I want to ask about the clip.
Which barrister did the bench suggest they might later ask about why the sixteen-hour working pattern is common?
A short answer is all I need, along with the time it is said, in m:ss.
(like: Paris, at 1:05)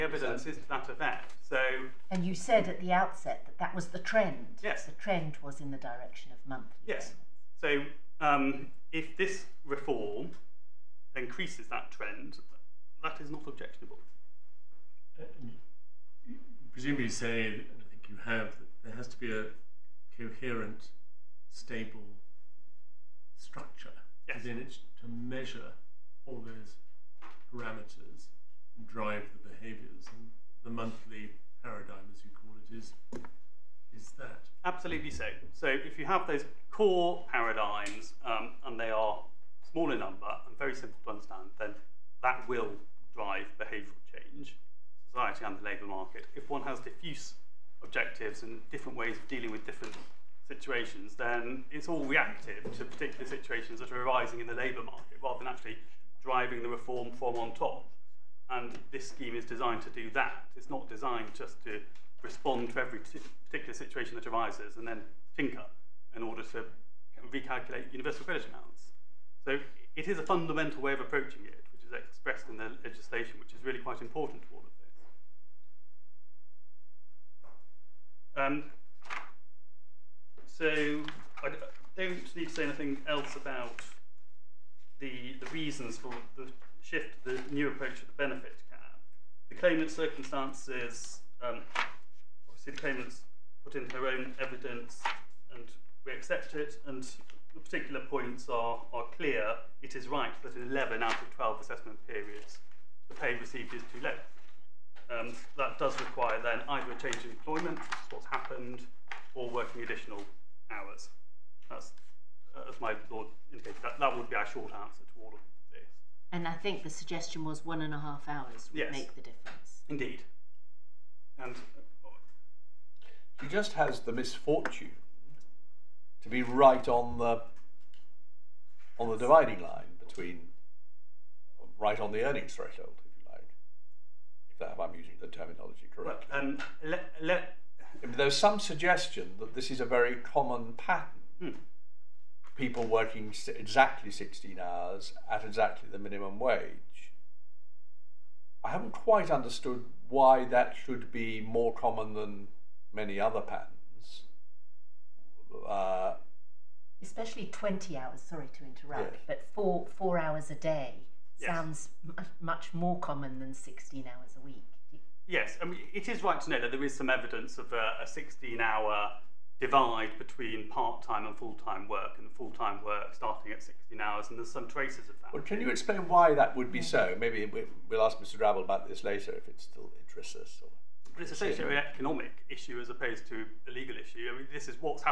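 Mr. Drabble, at 2:58.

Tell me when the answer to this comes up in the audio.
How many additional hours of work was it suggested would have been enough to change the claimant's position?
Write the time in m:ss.
1:57.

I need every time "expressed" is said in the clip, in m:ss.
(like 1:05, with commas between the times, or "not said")
1:11.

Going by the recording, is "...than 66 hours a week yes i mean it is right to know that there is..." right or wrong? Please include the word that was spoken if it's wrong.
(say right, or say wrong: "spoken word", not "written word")
wrong: "16", not "66".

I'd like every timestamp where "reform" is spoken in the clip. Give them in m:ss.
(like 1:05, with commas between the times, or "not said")
0:09, 0:56.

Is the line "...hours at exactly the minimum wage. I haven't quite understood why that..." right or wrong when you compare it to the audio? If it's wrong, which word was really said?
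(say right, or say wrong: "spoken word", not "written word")
right.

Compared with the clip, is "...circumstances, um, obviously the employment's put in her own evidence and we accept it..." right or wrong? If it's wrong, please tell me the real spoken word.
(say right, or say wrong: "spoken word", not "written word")
wrong: "claimant", not "employment".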